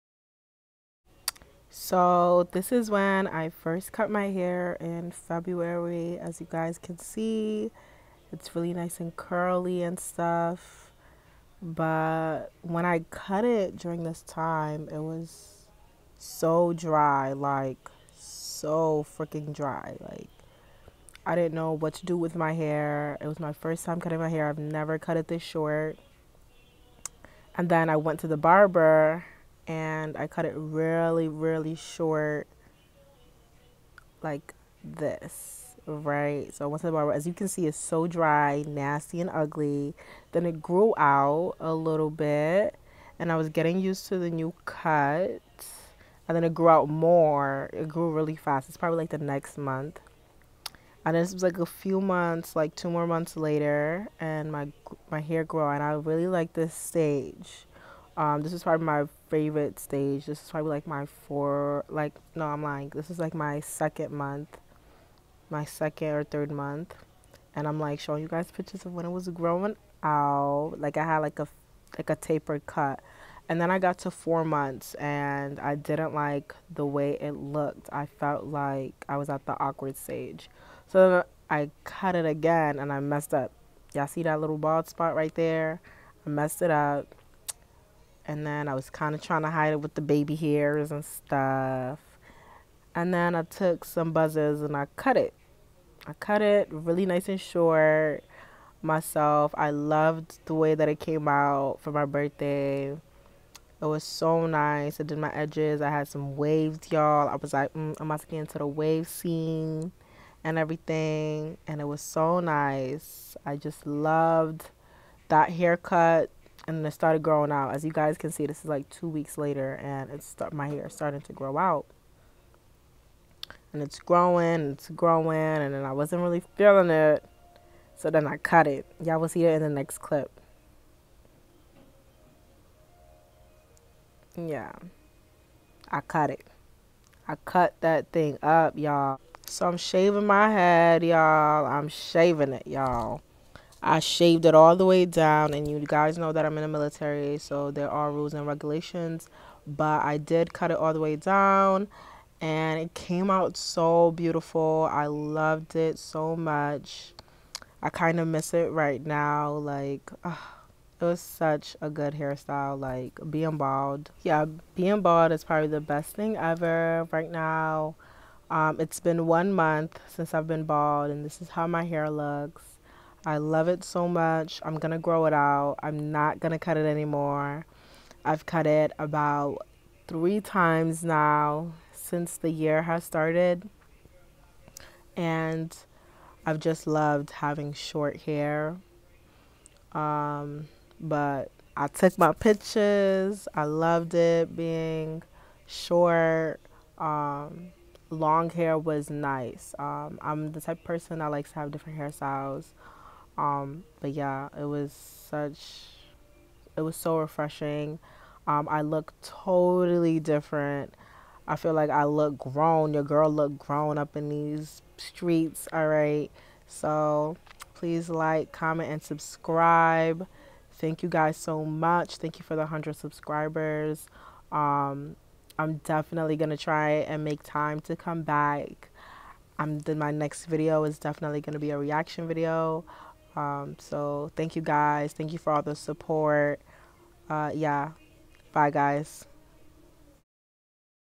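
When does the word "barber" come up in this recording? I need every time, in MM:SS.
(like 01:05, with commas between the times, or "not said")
00:28, 00:36.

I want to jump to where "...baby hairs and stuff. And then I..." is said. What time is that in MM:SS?
01:30.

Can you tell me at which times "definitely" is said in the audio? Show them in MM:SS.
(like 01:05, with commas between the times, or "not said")
03:45, 03:50.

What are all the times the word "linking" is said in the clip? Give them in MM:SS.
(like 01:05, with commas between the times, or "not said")
not said.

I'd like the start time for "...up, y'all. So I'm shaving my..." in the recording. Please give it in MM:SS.
02:18.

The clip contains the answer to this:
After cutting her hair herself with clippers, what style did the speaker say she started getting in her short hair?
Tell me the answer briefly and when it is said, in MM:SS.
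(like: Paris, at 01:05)
Waves, at 01:46.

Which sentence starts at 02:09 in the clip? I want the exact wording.
Y'all will see it in the next clip.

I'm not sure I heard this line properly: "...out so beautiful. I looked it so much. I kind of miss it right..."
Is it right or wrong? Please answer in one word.
wrong.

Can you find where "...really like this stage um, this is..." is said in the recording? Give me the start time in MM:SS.
00:55.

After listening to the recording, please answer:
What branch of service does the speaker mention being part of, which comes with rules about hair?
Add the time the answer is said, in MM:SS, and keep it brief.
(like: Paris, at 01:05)
Military, at 02:26.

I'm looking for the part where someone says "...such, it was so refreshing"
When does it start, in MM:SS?
03:24.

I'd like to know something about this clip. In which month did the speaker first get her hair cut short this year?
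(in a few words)
February.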